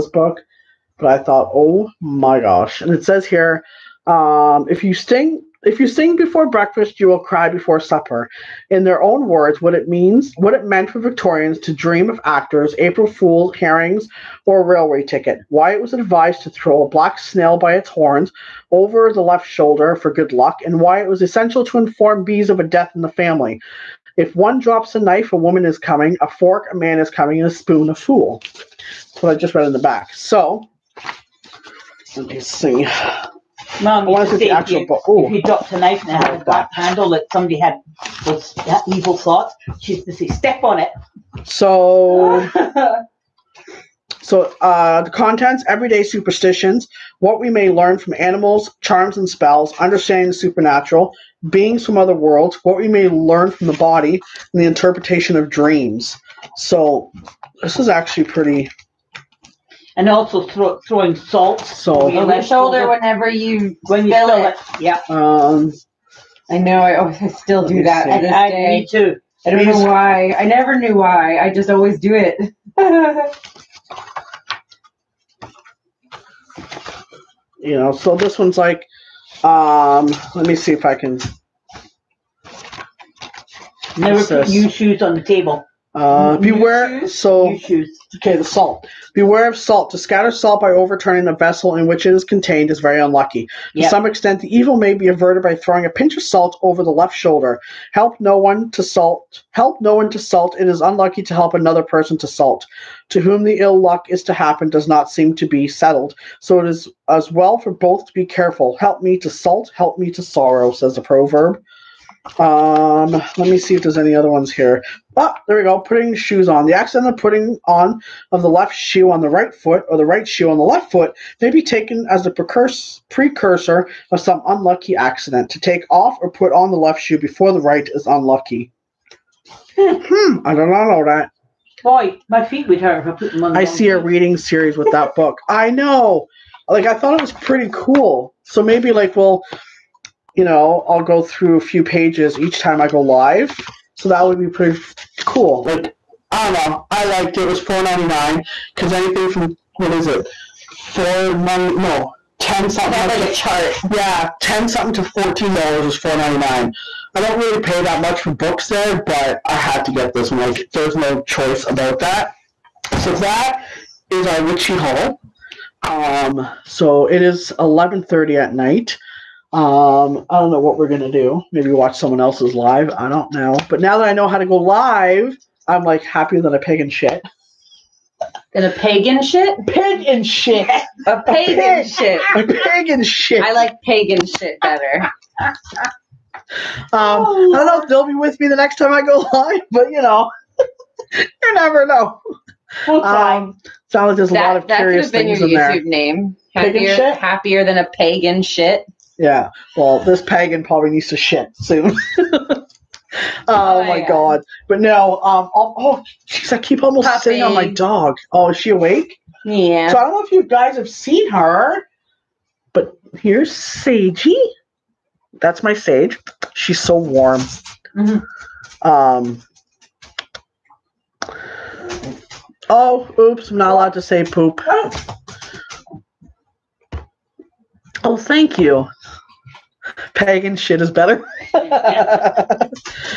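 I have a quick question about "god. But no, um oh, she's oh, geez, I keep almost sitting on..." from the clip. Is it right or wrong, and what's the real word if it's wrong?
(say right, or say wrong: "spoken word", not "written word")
right.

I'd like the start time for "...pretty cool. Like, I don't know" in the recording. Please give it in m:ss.
2:24.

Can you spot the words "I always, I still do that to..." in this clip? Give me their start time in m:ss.
1:06.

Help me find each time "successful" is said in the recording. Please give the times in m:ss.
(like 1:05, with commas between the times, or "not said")
not said.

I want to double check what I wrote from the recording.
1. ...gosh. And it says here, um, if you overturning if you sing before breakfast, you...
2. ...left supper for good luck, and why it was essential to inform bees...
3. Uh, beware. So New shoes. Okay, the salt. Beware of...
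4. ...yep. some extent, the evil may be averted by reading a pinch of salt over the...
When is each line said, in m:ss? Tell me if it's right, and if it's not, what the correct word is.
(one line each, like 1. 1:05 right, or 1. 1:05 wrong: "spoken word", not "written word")
1. 0:02 wrong: "sting", not "overturning"
2. 0:19 wrong: "shoulder", not "supper"
3. 1:25 right
4. 1:33 wrong: "throwing", not "reading".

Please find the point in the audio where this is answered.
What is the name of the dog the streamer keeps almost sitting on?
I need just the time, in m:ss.
3:33.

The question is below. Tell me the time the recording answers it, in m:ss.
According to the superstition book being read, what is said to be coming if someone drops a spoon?
0:27.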